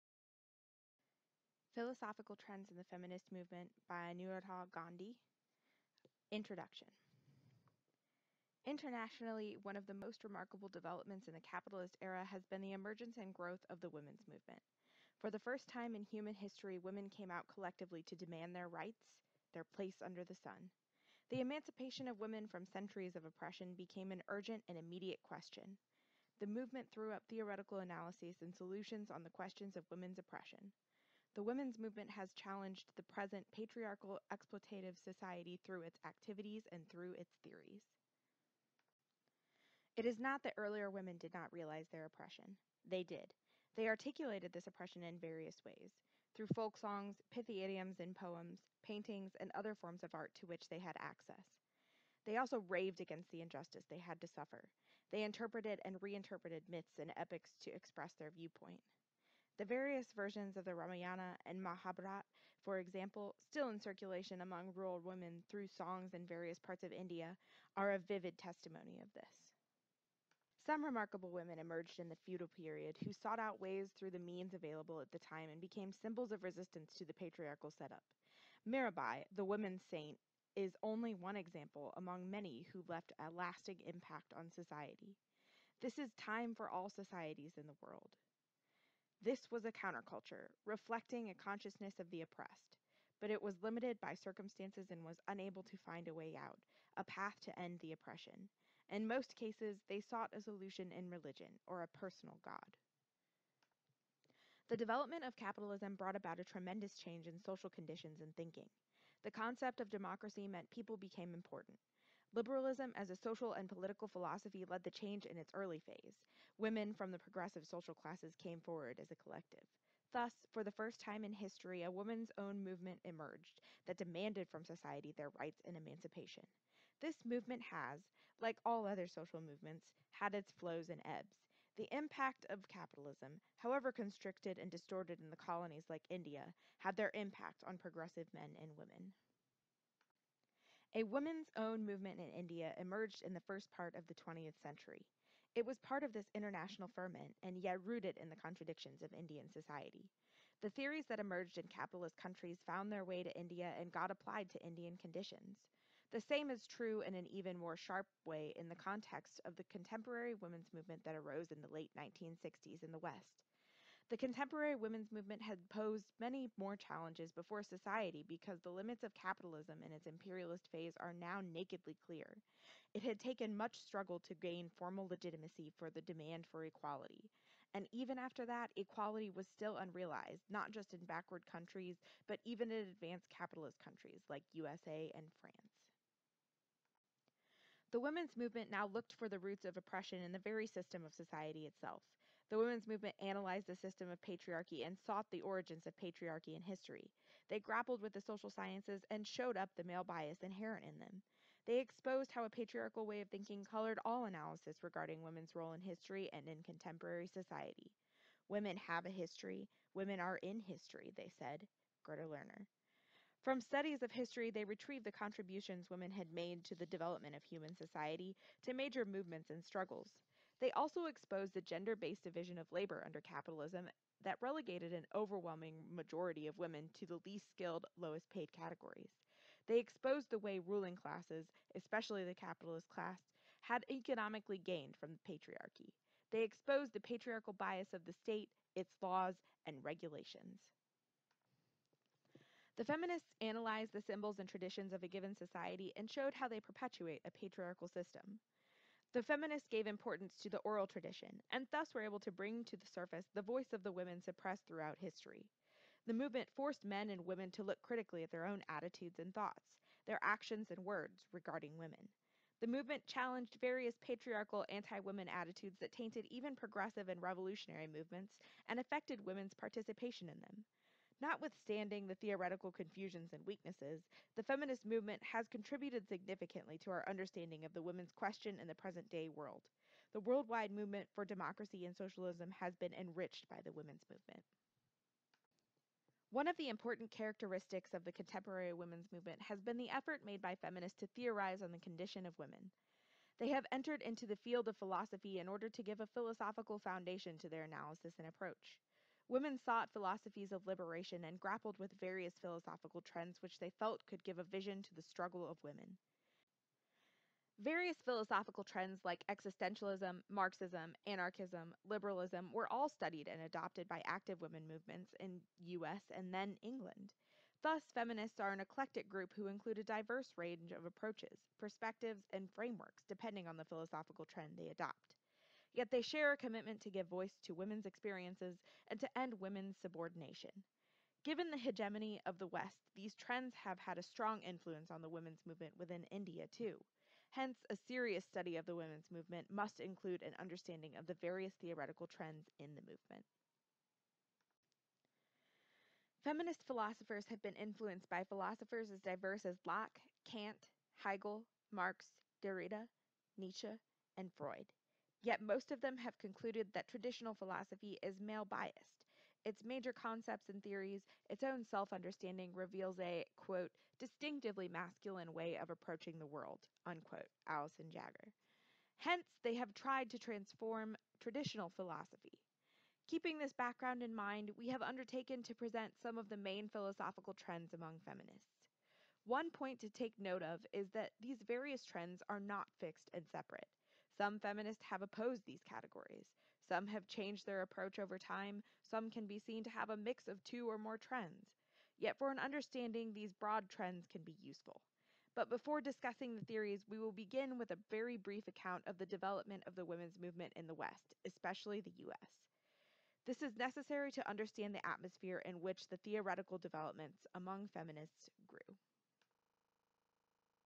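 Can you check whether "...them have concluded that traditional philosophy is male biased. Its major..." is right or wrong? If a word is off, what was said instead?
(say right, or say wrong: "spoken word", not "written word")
right.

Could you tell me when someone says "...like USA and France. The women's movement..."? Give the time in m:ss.
3:04.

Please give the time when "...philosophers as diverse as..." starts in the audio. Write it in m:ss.
5:48.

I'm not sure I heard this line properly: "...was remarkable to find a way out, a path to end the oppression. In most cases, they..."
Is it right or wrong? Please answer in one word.
wrong.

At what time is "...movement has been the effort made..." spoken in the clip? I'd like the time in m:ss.
4:49.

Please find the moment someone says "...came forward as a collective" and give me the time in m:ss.
1:58.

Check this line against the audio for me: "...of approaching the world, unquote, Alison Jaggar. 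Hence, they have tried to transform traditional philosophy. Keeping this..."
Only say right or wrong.
right.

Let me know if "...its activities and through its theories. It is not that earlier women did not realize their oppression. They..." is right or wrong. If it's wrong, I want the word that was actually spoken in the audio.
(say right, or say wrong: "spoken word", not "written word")
right.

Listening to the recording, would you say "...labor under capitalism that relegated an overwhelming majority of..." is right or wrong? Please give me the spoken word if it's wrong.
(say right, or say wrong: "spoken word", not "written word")
right.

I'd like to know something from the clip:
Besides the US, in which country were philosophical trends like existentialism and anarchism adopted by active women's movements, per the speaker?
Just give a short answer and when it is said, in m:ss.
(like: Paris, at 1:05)
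England, at 5:16.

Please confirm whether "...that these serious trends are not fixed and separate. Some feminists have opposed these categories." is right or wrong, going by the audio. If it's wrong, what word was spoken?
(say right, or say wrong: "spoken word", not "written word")
wrong: "various", not "serious".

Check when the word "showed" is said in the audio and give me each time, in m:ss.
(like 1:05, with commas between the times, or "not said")
3:19, 4:06.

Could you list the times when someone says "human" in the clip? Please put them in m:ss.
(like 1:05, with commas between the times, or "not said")
0:16, 3:37.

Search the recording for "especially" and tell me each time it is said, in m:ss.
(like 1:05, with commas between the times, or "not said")
3:51, 6:41.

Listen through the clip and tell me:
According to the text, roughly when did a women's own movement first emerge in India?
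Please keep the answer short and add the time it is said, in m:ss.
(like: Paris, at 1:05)
first part of the 20th century, at 2:23.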